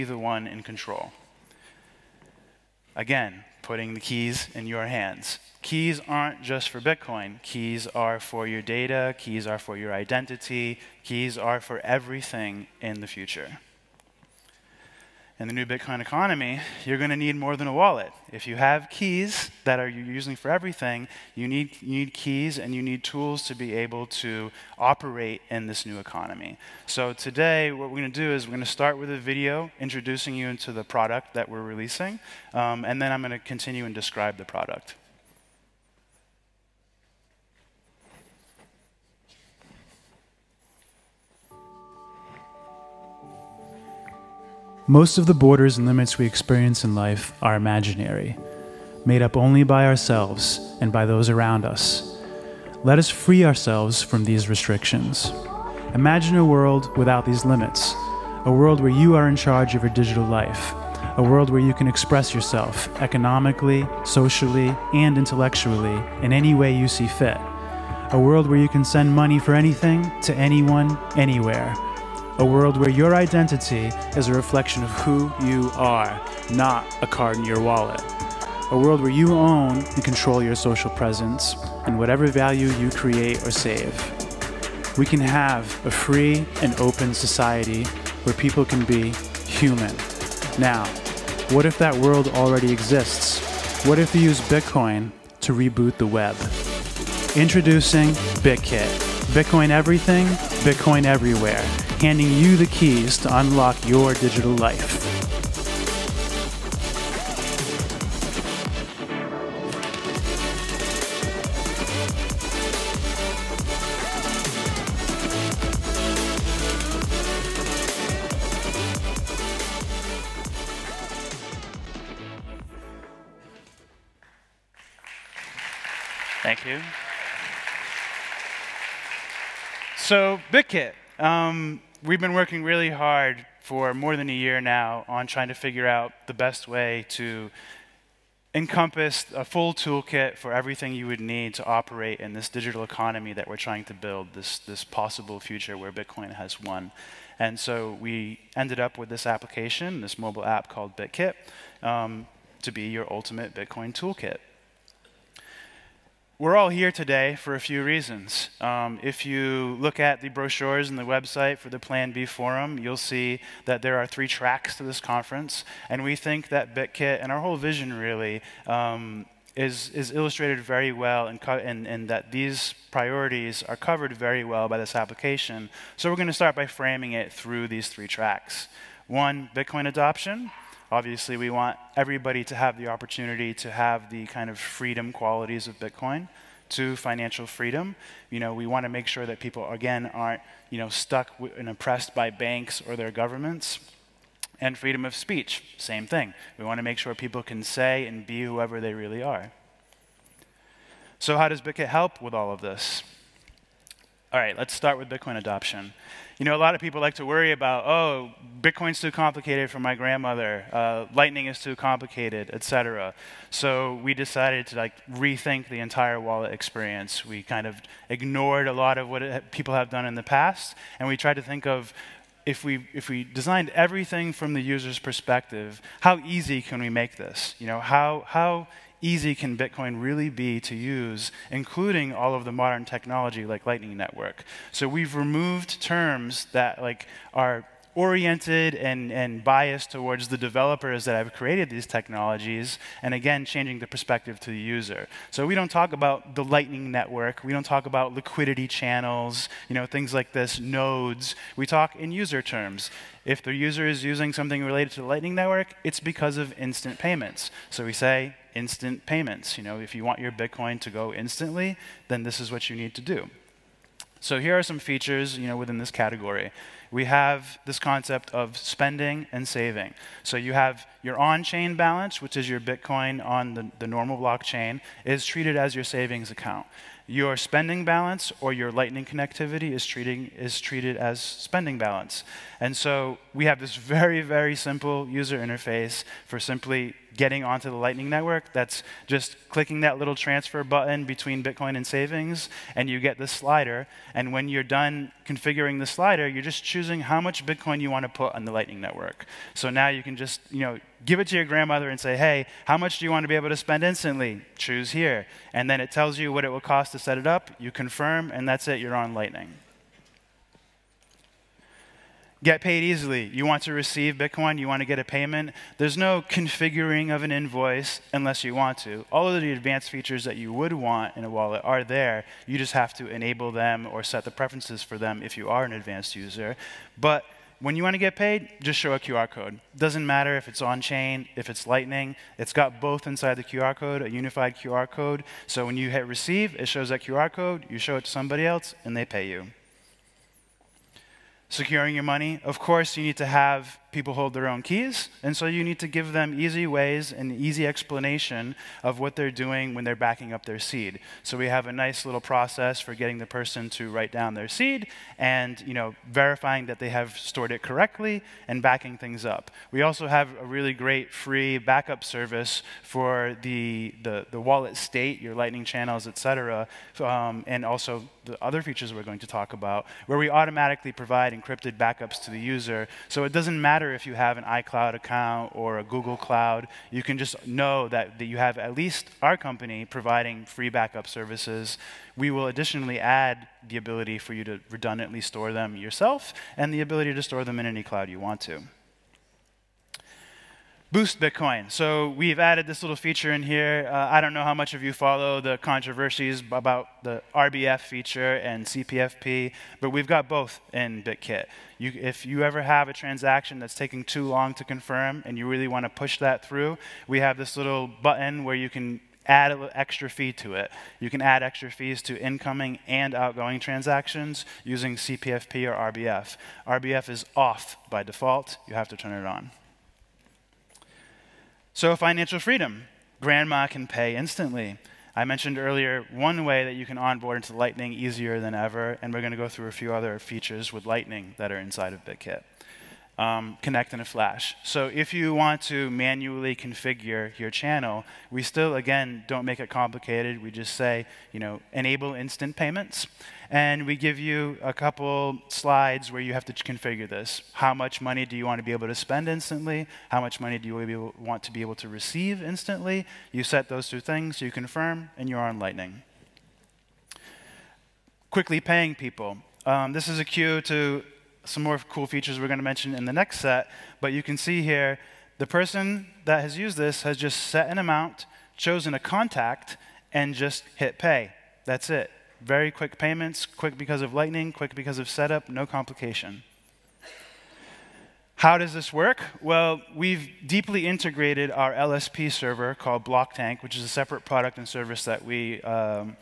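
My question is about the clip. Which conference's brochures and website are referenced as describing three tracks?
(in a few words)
Plan B Forum.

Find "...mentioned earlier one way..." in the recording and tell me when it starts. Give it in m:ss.
7:05.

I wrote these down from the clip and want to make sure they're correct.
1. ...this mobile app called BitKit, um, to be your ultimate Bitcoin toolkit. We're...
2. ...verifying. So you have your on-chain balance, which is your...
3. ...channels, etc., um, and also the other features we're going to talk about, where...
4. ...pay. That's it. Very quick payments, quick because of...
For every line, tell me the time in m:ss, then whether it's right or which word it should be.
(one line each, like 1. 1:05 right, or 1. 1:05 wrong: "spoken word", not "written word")
1. 2:30 right
2. 4:29 wrong: "saving", not "verifying"
3. 6:05 right
4. 7:50 right.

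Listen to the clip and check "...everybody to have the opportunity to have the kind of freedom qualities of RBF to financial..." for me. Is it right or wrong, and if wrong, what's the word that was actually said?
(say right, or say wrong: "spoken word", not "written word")
wrong: "Bitcoin", not "RBF".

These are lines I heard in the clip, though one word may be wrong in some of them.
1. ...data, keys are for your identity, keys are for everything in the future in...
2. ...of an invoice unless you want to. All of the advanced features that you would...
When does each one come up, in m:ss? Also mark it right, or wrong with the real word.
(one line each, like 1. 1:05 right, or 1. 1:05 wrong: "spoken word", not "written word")
1. 0:08 right
2. 5:17 right.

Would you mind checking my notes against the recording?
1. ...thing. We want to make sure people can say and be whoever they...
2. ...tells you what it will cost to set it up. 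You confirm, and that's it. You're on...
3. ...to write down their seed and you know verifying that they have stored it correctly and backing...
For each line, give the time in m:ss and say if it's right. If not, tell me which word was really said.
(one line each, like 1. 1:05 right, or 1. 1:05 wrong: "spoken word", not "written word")
1. 3:16 right
2. 5:05 right
3. 5:53 right.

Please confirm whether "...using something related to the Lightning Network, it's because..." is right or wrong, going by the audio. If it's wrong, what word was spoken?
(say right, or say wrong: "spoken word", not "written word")
right.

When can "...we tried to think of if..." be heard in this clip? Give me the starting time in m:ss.
3:41.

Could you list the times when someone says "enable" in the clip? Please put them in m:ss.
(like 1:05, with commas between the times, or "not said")
5:23, 7:21.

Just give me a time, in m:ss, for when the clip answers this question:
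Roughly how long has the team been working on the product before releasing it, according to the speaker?
2:13.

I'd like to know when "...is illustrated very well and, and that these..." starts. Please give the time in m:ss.
2:49.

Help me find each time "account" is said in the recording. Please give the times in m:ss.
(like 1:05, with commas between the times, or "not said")
4:36, 6:14.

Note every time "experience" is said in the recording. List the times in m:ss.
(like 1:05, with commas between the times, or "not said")
0:46, 3:36.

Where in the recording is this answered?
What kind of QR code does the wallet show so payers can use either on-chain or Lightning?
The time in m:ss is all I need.
5:34.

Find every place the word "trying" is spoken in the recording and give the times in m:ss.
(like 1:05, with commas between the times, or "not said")
2:15, 2:23.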